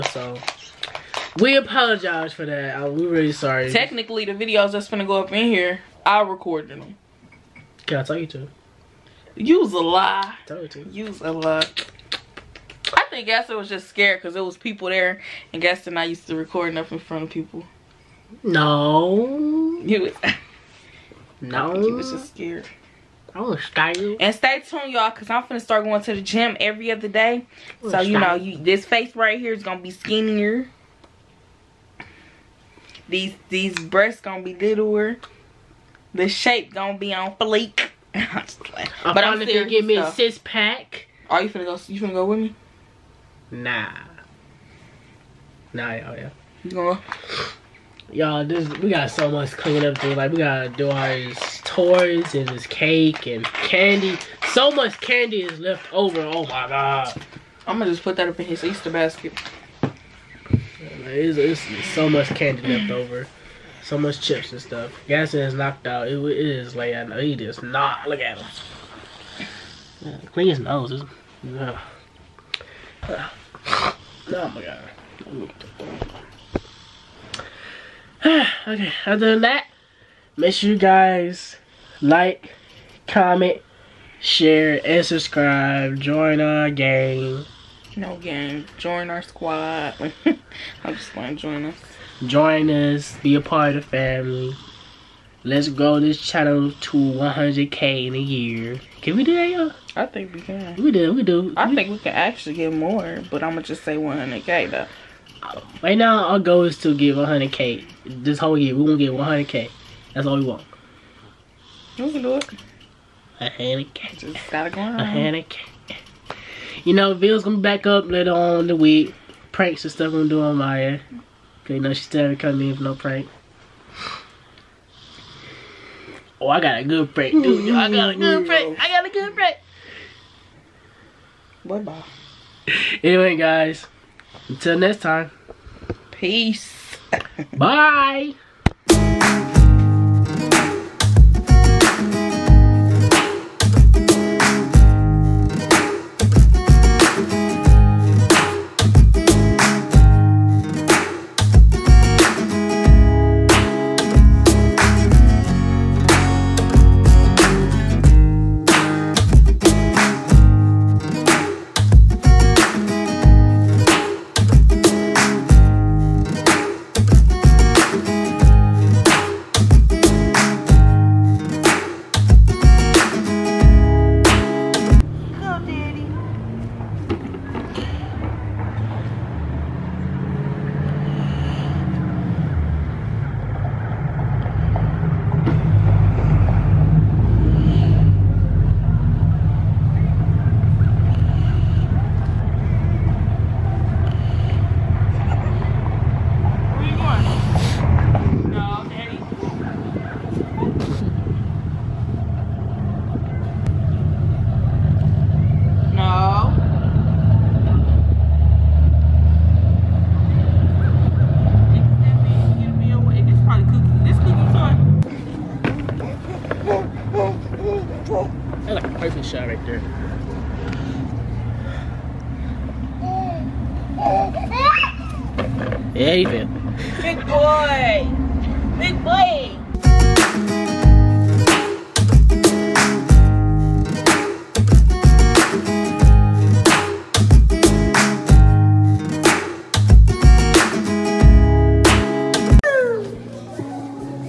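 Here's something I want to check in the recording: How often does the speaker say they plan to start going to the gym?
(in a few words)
every other day.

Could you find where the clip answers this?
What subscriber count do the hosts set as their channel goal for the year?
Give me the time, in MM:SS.
01:36.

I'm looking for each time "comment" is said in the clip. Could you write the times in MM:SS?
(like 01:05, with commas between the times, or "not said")
01:23.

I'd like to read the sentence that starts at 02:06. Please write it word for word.
Oh, I got a good prank, dude.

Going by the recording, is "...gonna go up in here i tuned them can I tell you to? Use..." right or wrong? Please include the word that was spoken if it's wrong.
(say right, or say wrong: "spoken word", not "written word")
wrong: "recorded", not "tuned".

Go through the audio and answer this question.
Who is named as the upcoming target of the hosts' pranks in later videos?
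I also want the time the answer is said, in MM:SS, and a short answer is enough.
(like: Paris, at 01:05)
Mya, at 02:00.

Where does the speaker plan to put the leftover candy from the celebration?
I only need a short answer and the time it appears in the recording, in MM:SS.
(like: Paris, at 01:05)
Easter basket, at 00:58.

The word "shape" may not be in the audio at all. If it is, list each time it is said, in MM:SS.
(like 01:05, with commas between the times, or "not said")
00:36.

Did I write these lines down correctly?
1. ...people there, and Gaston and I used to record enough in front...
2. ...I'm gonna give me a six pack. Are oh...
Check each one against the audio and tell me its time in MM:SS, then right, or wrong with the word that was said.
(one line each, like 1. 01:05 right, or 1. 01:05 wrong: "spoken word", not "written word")
1. 00:14 right
2. 00:39 right.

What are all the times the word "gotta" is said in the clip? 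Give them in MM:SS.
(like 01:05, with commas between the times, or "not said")
00:50, 01:54.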